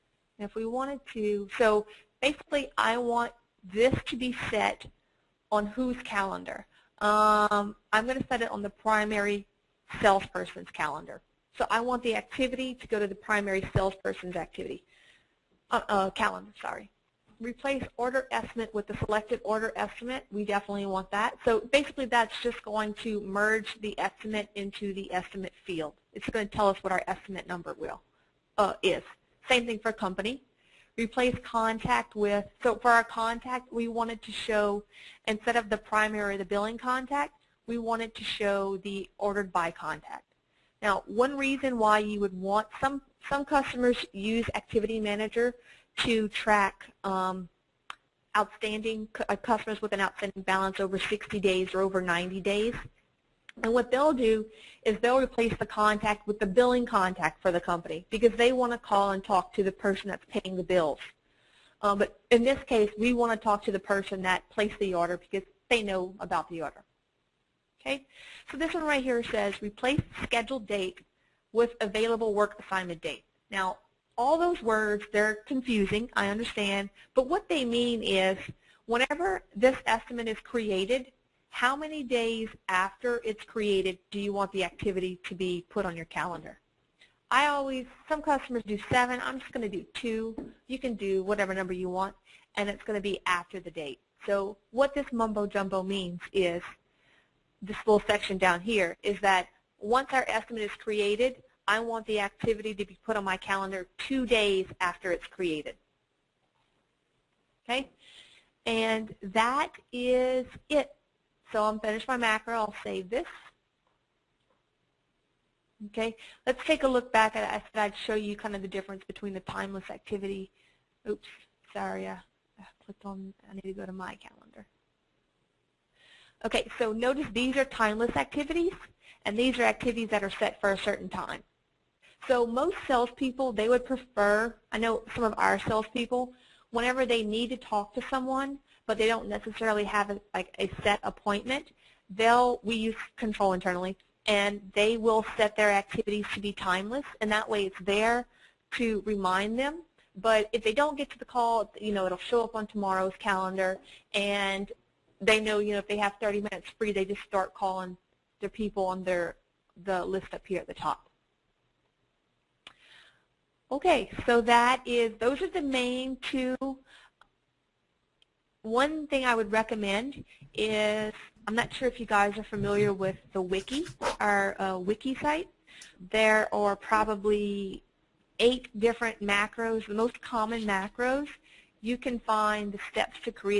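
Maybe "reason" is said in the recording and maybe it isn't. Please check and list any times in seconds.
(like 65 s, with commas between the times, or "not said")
41 s.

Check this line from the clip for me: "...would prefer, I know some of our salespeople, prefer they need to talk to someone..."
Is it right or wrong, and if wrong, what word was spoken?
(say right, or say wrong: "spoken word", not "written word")
wrong: "whenever", not "prefer".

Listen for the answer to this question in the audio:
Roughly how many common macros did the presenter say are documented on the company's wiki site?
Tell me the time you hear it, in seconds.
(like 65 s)
178 s.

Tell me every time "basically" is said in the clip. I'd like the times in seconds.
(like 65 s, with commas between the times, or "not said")
2 s, 21 s.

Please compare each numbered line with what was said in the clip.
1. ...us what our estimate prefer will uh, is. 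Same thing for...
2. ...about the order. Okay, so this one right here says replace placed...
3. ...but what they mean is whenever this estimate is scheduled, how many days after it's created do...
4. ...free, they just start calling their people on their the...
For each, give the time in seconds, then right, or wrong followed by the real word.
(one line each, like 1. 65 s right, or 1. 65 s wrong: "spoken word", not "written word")
1. 26 s wrong: "number", not "prefer"
2. 66 s wrong: "scheduled", not "placed"
3. 77 s wrong: "created", not "scheduled"
4. 156 s right.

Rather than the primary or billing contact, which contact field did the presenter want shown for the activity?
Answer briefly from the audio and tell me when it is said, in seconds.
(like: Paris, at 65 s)
Ordered by contact, at 39 s.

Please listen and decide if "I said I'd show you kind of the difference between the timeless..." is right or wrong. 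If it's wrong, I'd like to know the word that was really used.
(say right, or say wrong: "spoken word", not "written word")
right.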